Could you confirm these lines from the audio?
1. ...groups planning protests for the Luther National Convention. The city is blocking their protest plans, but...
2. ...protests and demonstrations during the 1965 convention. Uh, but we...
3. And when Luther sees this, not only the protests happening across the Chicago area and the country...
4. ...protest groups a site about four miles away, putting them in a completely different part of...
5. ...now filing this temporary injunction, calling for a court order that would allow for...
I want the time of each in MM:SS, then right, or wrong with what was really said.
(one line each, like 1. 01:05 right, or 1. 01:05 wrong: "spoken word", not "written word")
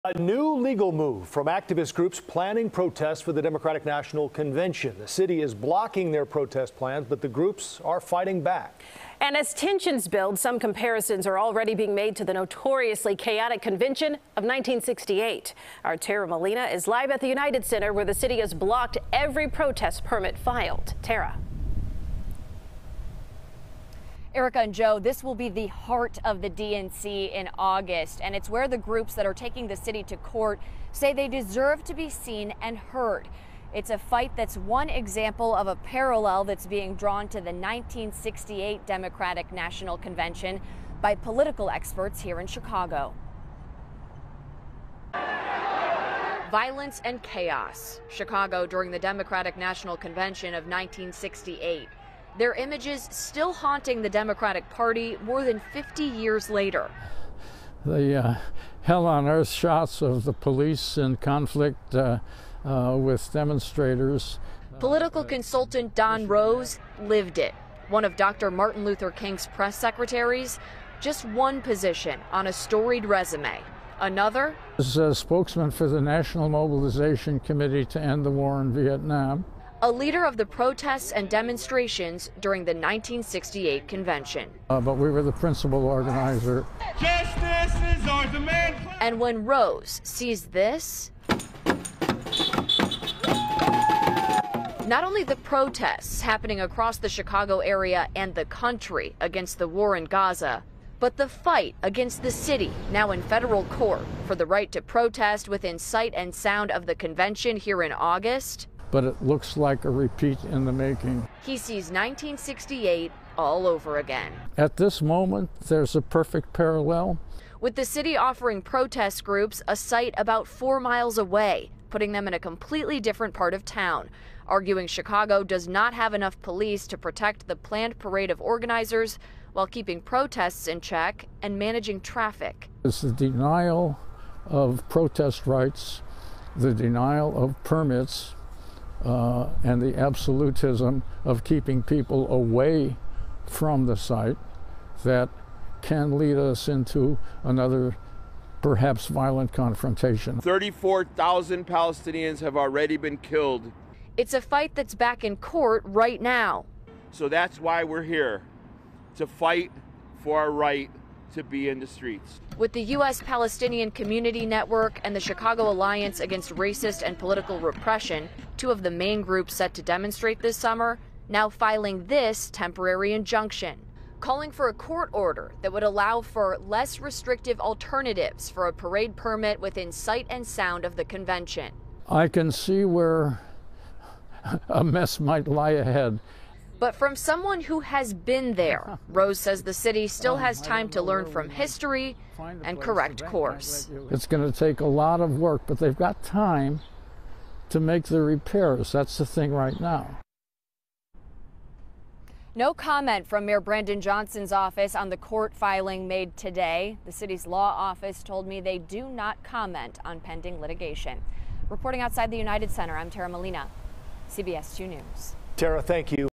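1. 00:01 wrong: "Democratic", not "Luther"
2. 01:20 wrong: "1968", not "1965"
3. 01:29 wrong: "Rose", not "Luther"
4. 01:58 right
5. 02:51 right.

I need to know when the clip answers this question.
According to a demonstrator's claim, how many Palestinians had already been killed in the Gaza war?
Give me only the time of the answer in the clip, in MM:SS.
02:30.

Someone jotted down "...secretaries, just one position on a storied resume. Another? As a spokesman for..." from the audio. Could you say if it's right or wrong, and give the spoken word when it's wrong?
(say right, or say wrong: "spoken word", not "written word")
right.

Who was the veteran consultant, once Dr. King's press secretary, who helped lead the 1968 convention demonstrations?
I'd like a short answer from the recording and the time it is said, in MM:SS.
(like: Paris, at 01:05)
Don Rose, at 01:05.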